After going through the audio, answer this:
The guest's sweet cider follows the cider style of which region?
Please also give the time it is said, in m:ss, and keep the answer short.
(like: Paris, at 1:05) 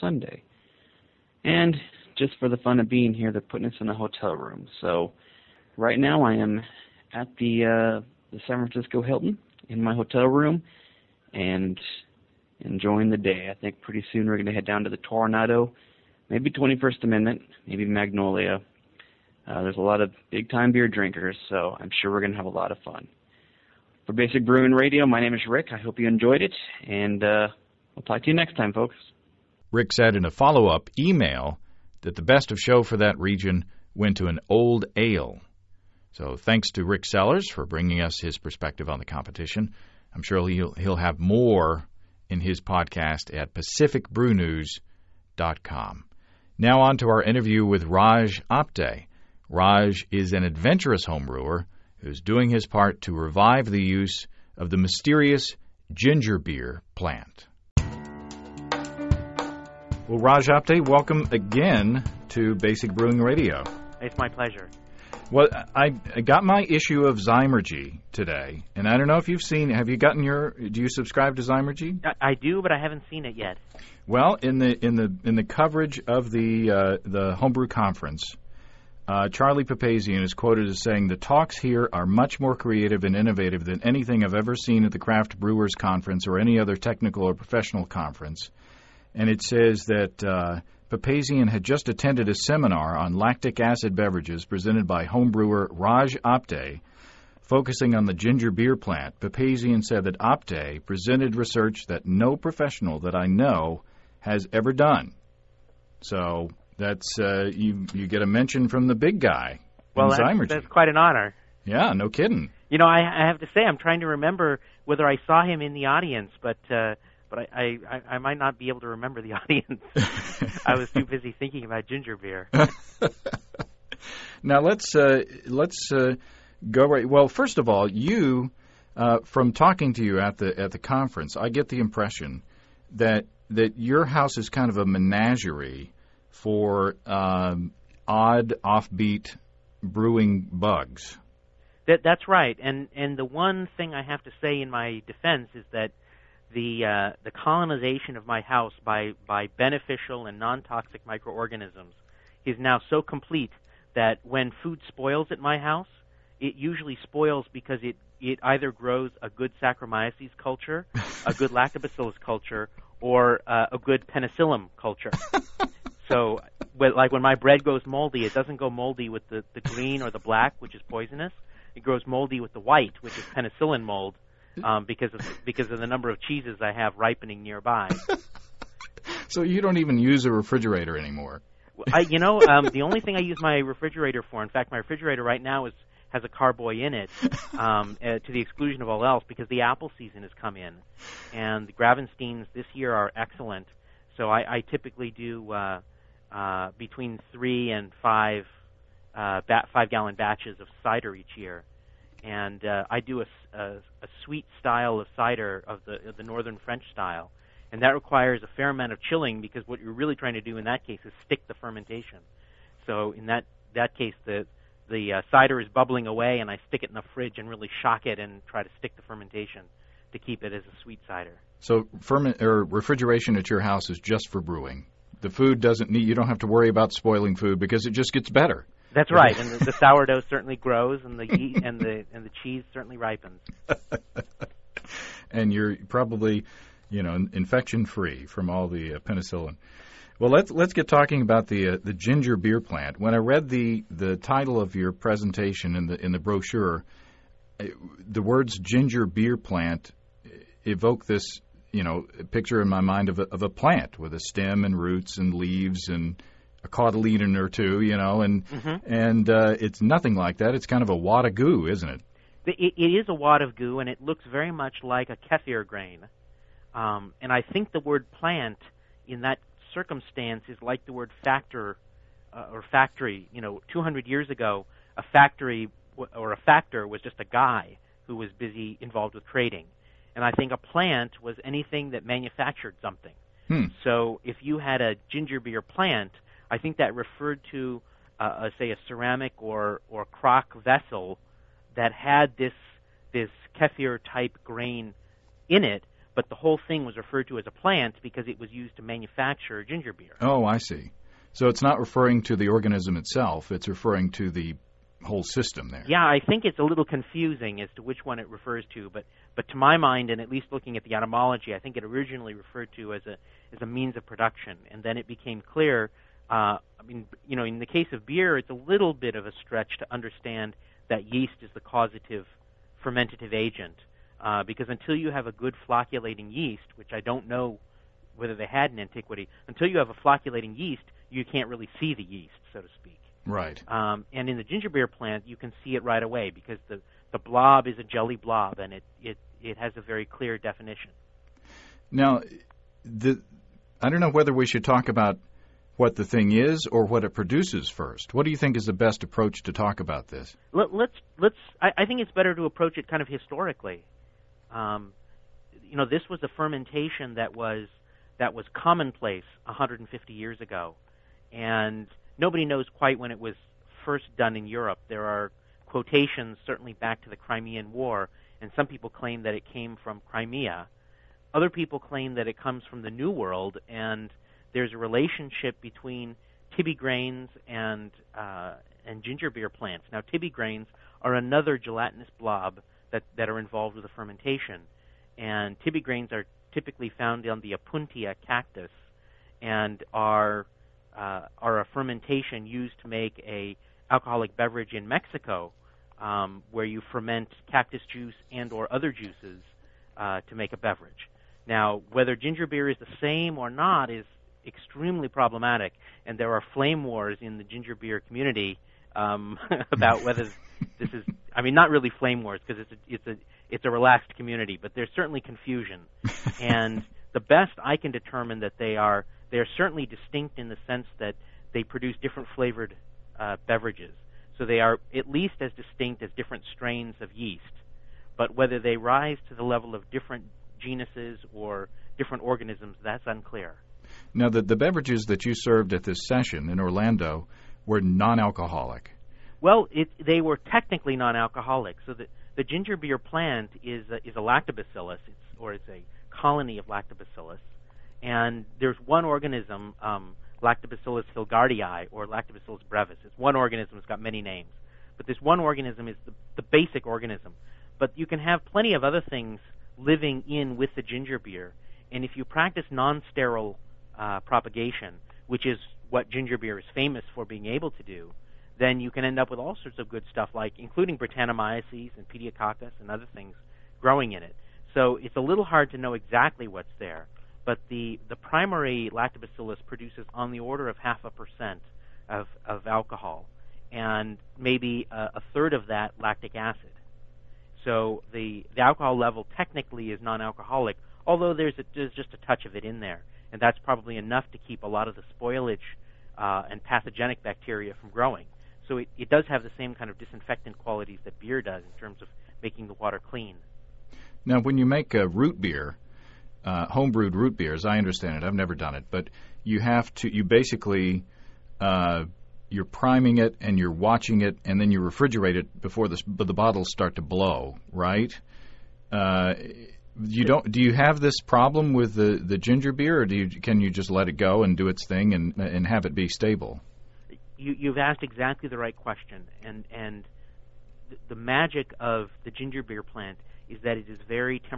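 northern French, at 3:26.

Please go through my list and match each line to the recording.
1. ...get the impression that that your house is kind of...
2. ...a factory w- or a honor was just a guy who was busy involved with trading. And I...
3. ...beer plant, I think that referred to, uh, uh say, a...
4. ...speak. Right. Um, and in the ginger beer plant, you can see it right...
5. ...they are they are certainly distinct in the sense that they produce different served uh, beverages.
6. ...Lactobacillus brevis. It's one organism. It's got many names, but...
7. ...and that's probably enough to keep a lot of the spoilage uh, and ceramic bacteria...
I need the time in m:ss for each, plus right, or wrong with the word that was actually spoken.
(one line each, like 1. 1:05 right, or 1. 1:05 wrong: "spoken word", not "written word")
1. 2:11 right
2. 4:34 wrong: "factor", not "honor"
3. 4:45 right
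4. 5:32 right
5. 6:58 wrong: "flavored", not "served"
6. 7:32 right
7. 8:13 wrong: "pathogenic", not "ceramic".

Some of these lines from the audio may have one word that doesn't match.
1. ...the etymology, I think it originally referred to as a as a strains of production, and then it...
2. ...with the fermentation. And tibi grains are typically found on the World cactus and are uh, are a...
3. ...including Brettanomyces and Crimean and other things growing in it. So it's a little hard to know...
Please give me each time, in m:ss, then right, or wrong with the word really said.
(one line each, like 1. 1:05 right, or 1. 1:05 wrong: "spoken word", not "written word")
1. 5:10 wrong: "means", not "strains"
2. 6:23 wrong: "Opuntia", not "World"
3. 7:50 wrong: "Pediococcus", not "Crimean".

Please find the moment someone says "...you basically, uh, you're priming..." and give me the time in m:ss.
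8:30.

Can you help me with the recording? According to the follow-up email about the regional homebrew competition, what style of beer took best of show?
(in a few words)
old ale.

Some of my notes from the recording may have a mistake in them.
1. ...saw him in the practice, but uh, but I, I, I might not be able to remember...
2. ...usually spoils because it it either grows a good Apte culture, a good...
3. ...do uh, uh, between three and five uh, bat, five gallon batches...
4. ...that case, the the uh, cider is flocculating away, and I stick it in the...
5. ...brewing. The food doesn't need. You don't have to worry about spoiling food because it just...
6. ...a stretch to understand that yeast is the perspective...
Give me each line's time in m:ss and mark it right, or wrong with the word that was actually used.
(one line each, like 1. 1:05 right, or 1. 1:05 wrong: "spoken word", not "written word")
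1. 1:55 wrong: "audience", not "practice"
2. 2:36 wrong: "Saccharomyces", not "Apte"
3. 3:15 right
4. 3:33 wrong: "bubbling", not "flocculating"
5. 3:44 right
6. 5:19 wrong: "causative", not "perspective".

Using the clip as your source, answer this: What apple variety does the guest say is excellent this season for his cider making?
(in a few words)
Gravensteins.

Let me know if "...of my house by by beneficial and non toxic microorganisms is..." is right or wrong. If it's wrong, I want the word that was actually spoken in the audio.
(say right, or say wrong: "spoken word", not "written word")
right.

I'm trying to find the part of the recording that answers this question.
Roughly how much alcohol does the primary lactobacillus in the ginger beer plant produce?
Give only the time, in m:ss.
8:00.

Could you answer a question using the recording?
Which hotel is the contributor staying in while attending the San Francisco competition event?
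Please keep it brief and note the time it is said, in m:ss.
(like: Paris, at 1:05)
San Francisco Hilton, at 0:08.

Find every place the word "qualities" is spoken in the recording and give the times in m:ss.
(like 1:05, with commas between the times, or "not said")
8:20.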